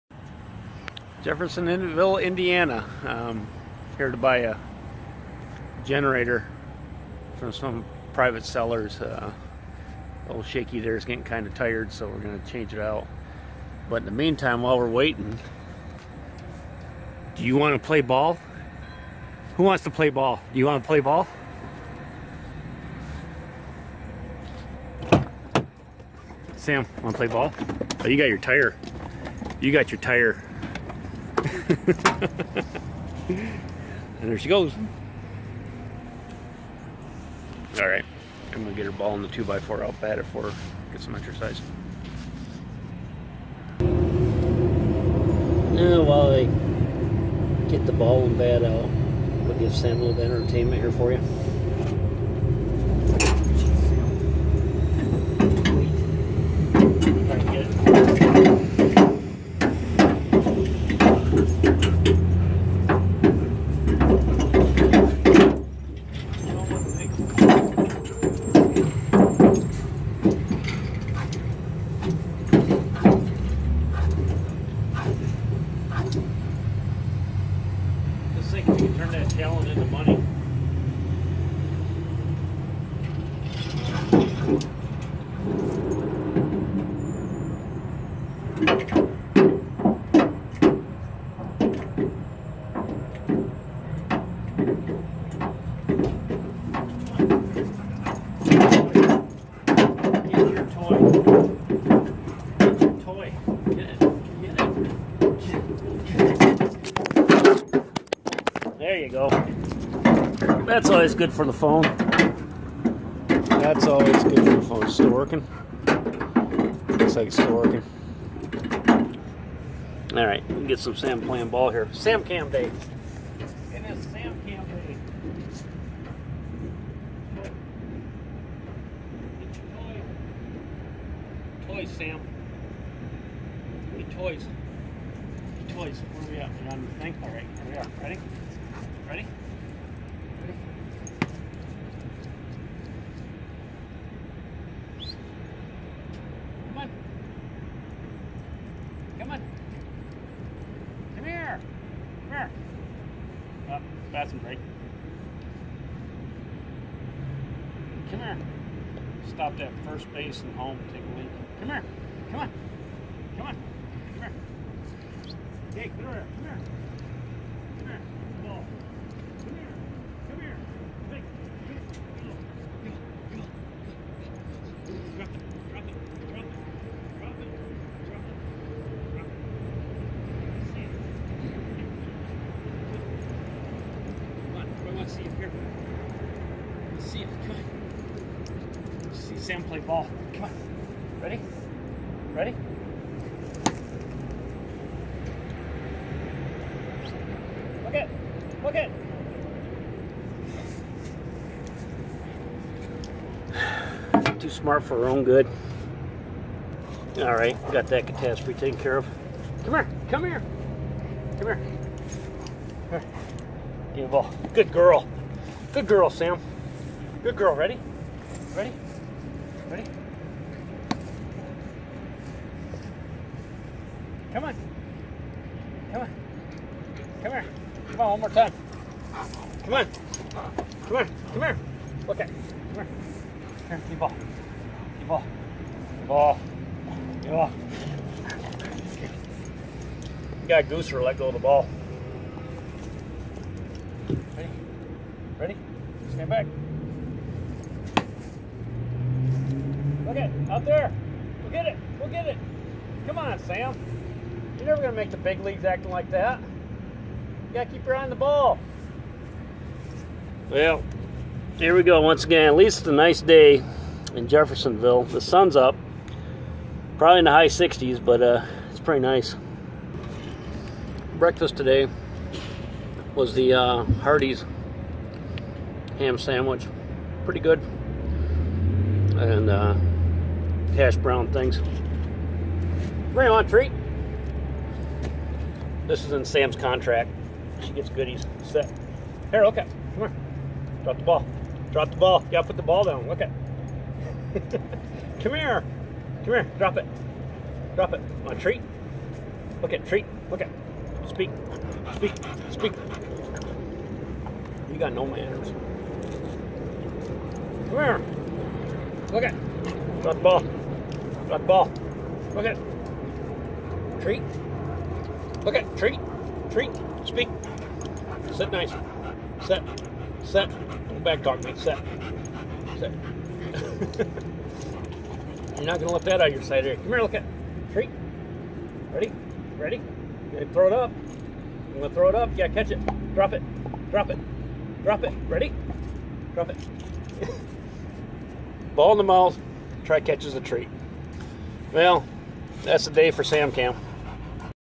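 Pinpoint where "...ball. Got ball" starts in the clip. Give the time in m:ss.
5:10.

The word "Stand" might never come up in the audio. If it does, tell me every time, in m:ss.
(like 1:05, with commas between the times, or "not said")
4:06.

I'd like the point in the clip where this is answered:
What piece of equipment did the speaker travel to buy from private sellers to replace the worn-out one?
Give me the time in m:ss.
0:05.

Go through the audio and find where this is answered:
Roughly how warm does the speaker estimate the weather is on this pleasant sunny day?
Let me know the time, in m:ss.
4:27.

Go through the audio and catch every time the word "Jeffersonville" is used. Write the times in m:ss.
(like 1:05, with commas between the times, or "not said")
0:01, 4:24.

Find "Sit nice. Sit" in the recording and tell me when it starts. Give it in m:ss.
5:18.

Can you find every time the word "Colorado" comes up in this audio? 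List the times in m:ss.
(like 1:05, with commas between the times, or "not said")
not said.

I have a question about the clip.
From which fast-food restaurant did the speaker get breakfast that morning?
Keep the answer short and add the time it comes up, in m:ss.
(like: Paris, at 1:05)
Hardee's, at 4:34.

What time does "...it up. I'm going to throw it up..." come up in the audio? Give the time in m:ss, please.
5:30.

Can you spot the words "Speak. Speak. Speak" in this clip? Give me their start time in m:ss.
5:01.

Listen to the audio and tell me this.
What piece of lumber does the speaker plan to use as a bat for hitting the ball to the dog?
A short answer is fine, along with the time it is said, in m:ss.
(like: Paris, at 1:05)
2 by 4, at 0:39.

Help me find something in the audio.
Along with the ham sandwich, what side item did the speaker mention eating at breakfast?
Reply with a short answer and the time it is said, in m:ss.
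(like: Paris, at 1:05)
hash brown things, at 4:40.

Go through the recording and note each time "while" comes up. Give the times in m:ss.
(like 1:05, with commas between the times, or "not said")
0:14, 0:46.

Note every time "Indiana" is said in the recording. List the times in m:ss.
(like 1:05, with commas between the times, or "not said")
0:02.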